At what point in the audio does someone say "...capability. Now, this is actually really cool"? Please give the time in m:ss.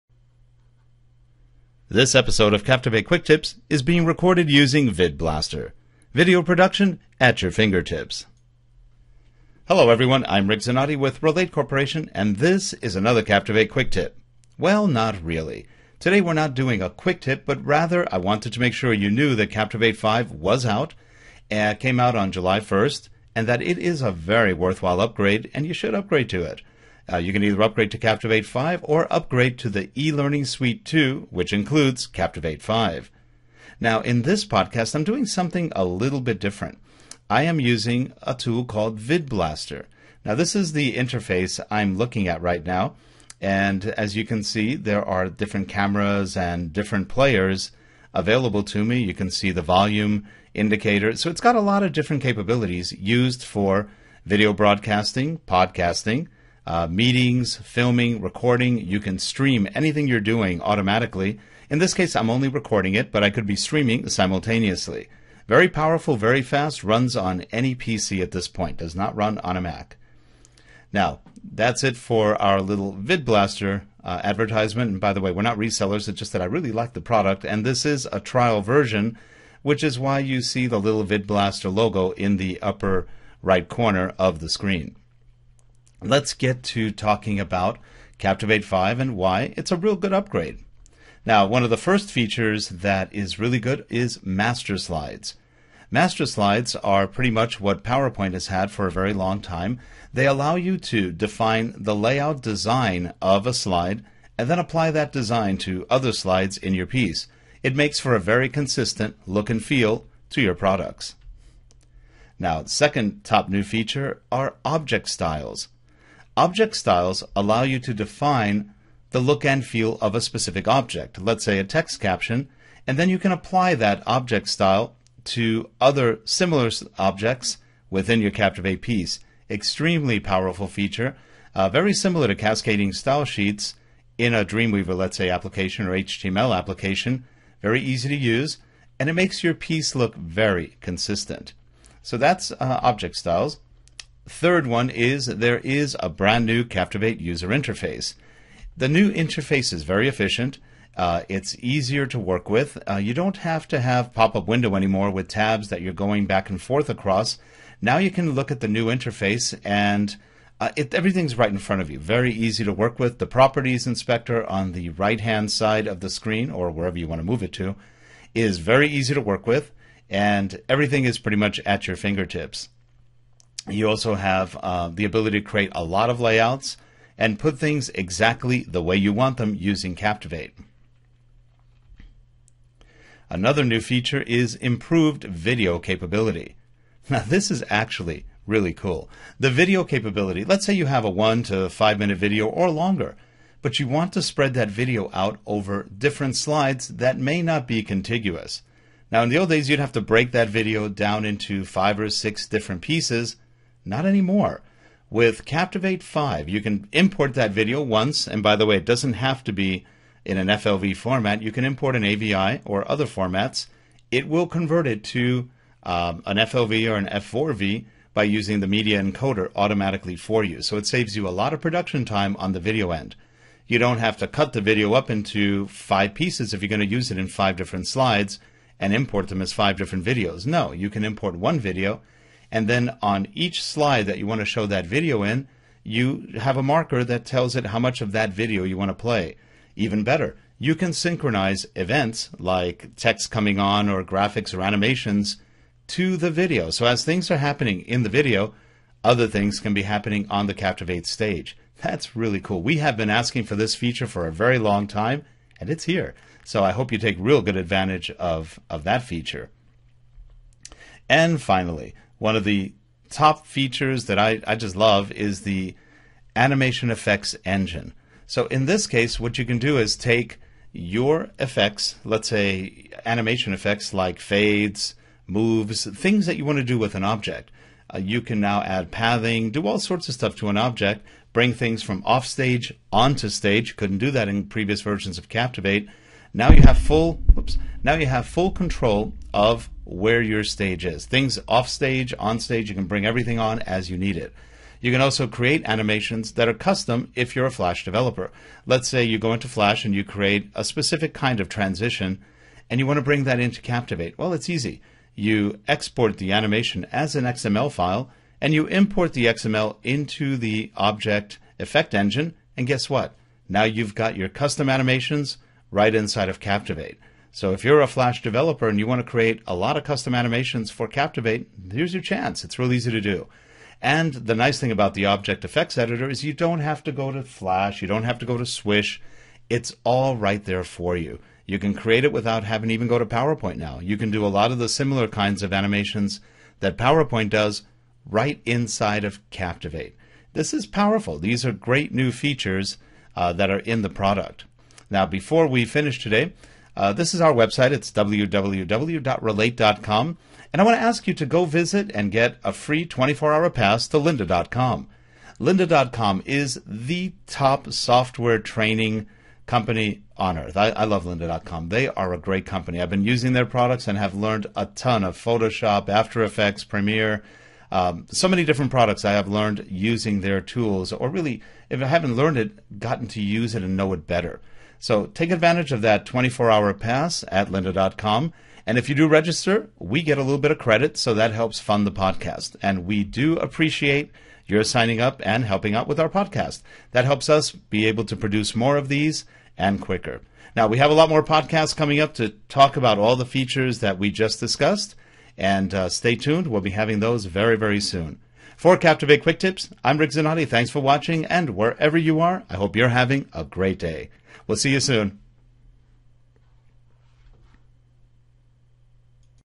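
3:05.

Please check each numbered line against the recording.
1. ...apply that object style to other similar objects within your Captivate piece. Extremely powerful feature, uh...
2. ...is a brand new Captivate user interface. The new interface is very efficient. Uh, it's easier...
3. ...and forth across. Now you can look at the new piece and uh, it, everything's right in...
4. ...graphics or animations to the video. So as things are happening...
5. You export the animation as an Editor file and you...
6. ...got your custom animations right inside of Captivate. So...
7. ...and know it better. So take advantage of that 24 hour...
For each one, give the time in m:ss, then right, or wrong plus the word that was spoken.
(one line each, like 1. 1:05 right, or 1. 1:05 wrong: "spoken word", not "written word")
1. 2:03 right
2. 2:25 right
3. 2:36 wrong: "interface", not "piece"
4. 4:04 right
5. 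5:05 wrong: "XML", not "Editor"
6. 5:13 right
7. 6:13 right.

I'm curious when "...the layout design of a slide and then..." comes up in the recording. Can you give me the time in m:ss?
1:41.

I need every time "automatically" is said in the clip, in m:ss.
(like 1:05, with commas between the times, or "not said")
1:00, 3:39.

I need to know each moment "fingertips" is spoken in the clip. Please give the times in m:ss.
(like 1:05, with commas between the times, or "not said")
0:07, 2:51.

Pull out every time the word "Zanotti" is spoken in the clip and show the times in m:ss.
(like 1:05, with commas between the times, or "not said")
0:10, 6:40.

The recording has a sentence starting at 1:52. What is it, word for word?
Now, second top new feature are object styles.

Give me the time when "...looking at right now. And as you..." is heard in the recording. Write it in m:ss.
0:41.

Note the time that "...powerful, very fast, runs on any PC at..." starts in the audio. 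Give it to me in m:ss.
1:05.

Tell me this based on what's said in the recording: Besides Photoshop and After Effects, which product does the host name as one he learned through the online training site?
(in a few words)
Premiere.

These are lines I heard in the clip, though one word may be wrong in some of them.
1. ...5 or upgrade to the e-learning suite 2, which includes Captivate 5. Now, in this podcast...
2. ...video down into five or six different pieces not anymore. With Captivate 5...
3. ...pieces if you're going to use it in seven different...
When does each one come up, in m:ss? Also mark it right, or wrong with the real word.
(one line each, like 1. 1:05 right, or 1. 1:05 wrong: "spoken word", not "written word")
1. 0:28 right
2. 3:20 right
3. 3:46 wrong: "five", not "seven".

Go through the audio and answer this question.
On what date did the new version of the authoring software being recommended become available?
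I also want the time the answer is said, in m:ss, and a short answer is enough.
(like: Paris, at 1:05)
July 1st, at 0:22.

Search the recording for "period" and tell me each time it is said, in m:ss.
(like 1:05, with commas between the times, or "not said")
not said.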